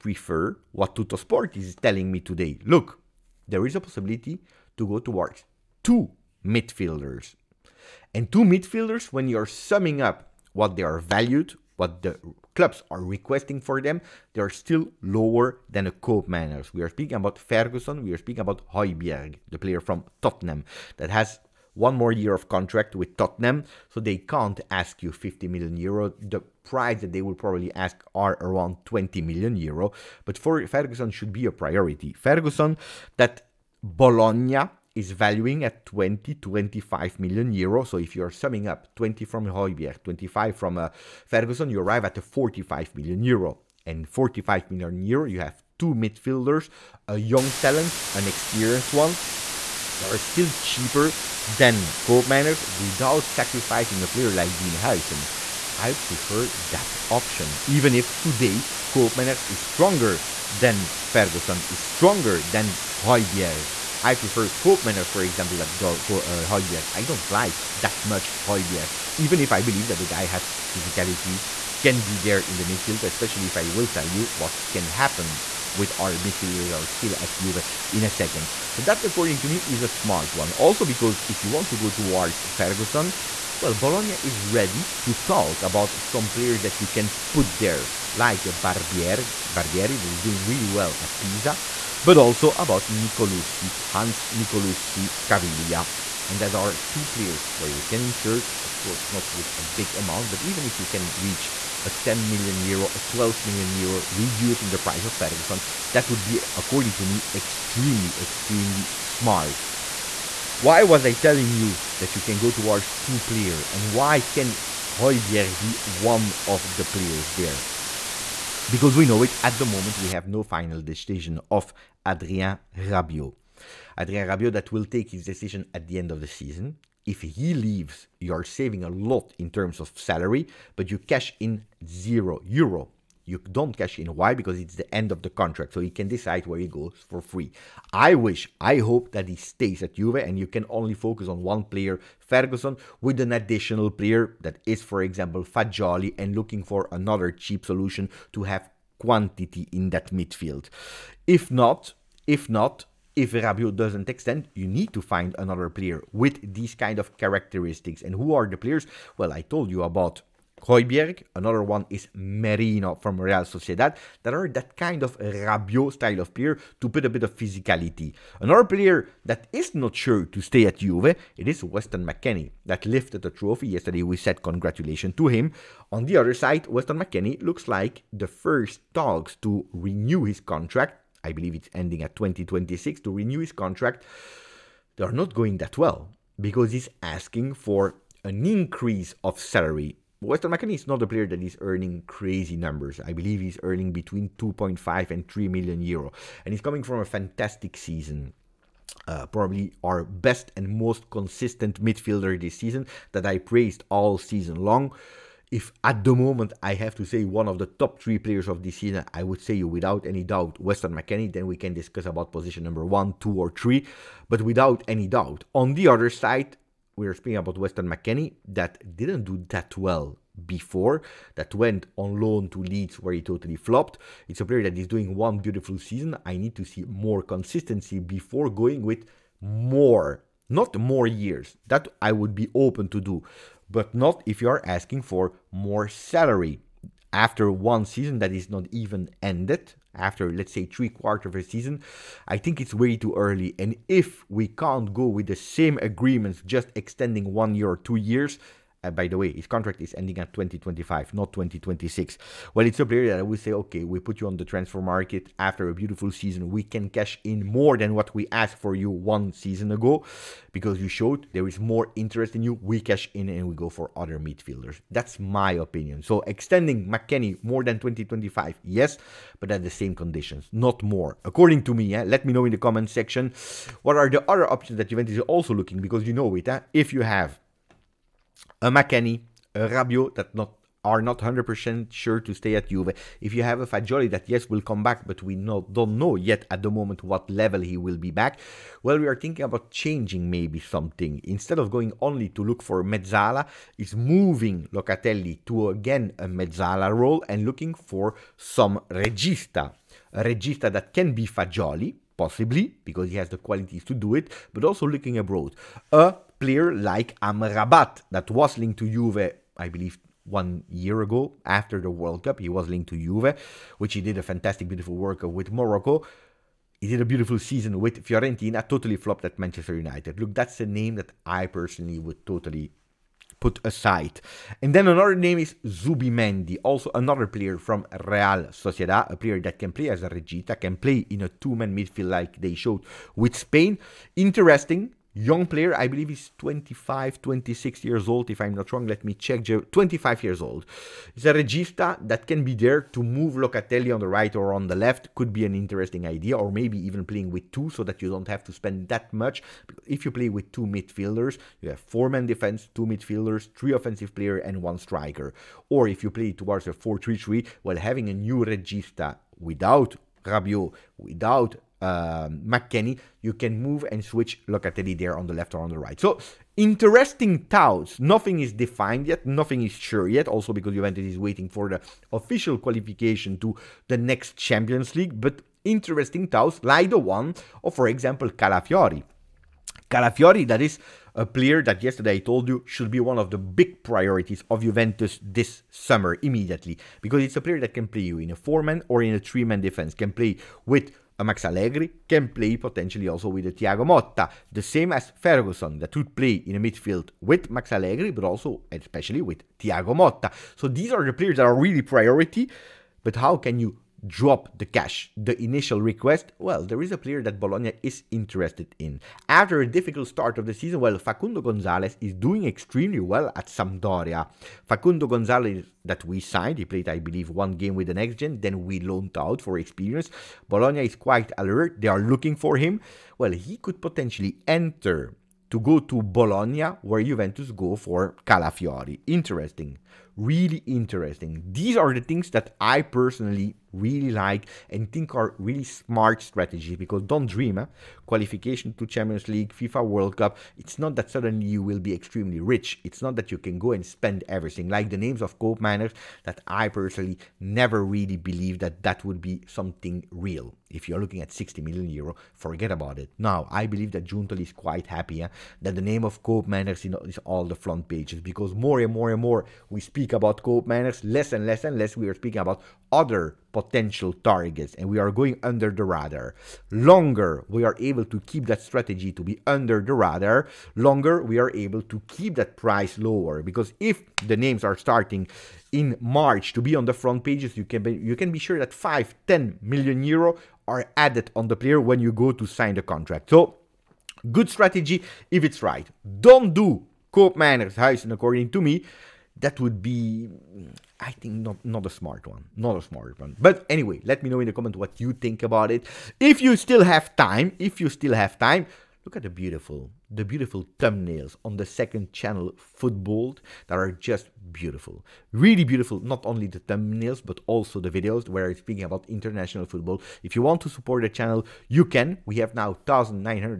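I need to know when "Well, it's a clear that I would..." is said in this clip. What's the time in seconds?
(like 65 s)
252 s.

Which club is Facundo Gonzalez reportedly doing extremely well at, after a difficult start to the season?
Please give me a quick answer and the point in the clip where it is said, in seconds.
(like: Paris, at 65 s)
Sampdoria, at 410 s.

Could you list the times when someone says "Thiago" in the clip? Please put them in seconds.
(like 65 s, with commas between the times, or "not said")
393 s, 399 s.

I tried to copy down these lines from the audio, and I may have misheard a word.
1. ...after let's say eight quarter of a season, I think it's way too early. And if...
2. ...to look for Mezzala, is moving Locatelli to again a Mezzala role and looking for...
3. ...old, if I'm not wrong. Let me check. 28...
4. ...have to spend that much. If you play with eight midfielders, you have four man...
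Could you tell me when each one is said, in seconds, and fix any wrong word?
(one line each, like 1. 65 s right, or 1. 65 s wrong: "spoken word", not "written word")
1. 239 s wrong: "three", not "eight"
2. 292 s right
3. 338 s wrong: "25", not "28"
4. 348 s wrong: "two", not "eight".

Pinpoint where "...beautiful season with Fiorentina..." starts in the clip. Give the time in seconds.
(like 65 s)
317 s.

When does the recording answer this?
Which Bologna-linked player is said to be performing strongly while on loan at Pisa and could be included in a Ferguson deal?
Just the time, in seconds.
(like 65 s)
89 s.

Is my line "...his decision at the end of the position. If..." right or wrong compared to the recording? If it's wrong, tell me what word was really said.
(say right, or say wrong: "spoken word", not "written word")
wrong: "season", not "position".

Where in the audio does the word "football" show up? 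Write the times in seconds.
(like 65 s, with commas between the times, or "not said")
502 s, 509 s.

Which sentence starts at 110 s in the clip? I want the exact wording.
Why was I telling you that you can go towards two player and why can Højbjerg be one of the players there?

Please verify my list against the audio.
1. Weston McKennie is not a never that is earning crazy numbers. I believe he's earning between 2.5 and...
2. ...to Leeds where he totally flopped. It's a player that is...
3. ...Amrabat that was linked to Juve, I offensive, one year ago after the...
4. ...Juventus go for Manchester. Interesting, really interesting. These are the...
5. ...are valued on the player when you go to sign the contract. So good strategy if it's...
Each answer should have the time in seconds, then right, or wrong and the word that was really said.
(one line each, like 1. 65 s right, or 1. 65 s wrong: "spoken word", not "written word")
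1. 190 s wrong: "player", not "never"
2. 222 s right
3. 307 s wrong: "believe", not "offensive"
4. 427 s wrong: "Calafiori", not "Manchester"
5. 480 s wrong: "added", not "valued".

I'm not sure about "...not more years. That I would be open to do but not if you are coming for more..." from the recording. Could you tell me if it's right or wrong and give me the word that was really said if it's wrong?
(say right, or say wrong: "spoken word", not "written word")
wrong: "asking", not "coming".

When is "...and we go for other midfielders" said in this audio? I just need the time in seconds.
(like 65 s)
263 s.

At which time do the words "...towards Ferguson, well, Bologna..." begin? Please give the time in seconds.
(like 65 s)
81 s.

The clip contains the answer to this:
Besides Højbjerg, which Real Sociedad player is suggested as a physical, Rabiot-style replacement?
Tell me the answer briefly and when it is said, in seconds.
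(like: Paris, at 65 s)
Merino, at 162 s.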